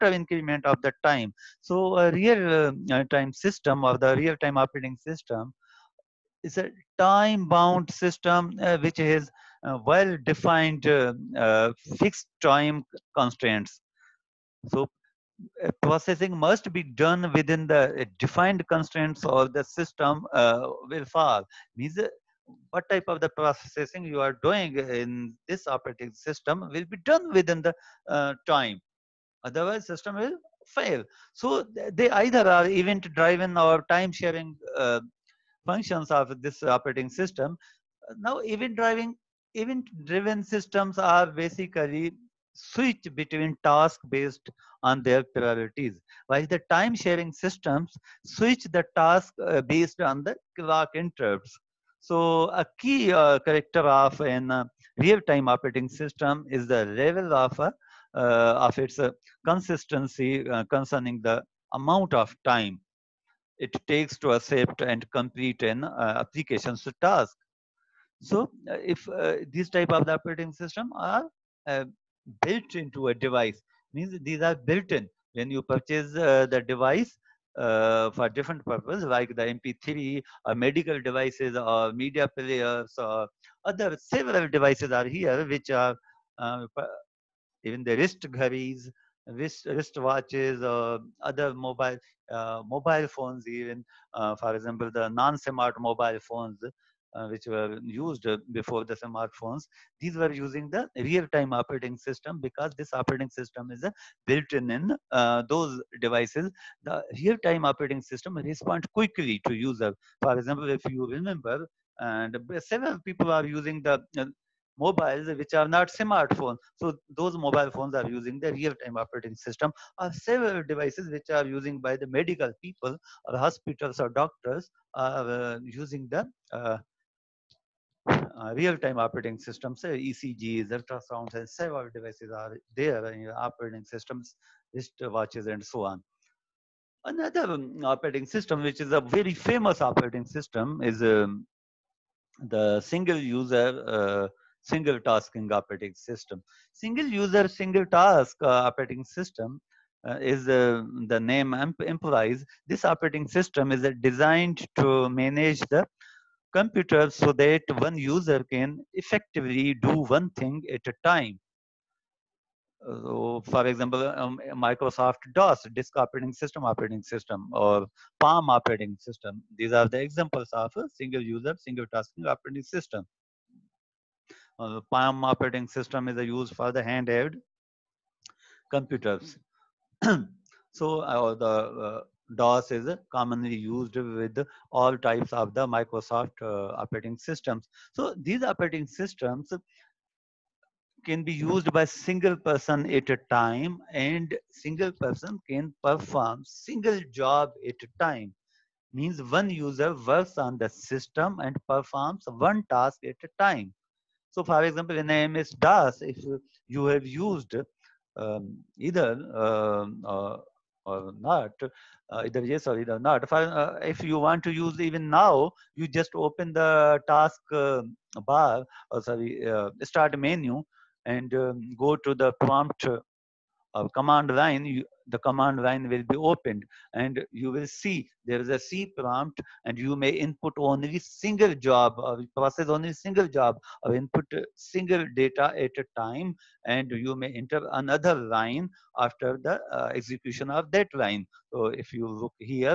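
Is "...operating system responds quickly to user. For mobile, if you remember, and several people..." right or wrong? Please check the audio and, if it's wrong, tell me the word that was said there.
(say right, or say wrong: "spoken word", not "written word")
wrong: "example", not "mobile".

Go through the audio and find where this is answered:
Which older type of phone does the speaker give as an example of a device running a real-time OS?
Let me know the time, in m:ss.
1:35.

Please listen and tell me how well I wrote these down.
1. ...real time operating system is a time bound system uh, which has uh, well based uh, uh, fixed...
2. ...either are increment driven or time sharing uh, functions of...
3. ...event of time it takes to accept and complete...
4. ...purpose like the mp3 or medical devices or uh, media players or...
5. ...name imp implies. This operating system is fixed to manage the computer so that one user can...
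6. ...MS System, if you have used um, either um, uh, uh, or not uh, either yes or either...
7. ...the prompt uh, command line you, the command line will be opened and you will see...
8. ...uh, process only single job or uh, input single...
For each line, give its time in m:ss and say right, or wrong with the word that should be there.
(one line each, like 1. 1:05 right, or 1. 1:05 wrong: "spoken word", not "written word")
1. 0:04 wrong: "defined", not "based"
2. 0:32 wrong: "event", not "increment"
3. 1:01 wrong: "amount", not "event"
4. 1:18 right
5. 2:31 wrong: "designed", not "fixed"
6. 3:25 wrong: "DOS", not "System"
7. 3:42 right
8. 3:52 right.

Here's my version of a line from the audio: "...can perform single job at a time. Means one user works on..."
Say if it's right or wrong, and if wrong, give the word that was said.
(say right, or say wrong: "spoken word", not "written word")
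right.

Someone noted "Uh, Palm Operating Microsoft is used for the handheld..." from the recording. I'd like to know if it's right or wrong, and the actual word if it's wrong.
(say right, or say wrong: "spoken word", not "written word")
wrong: "System", not "Microsoft".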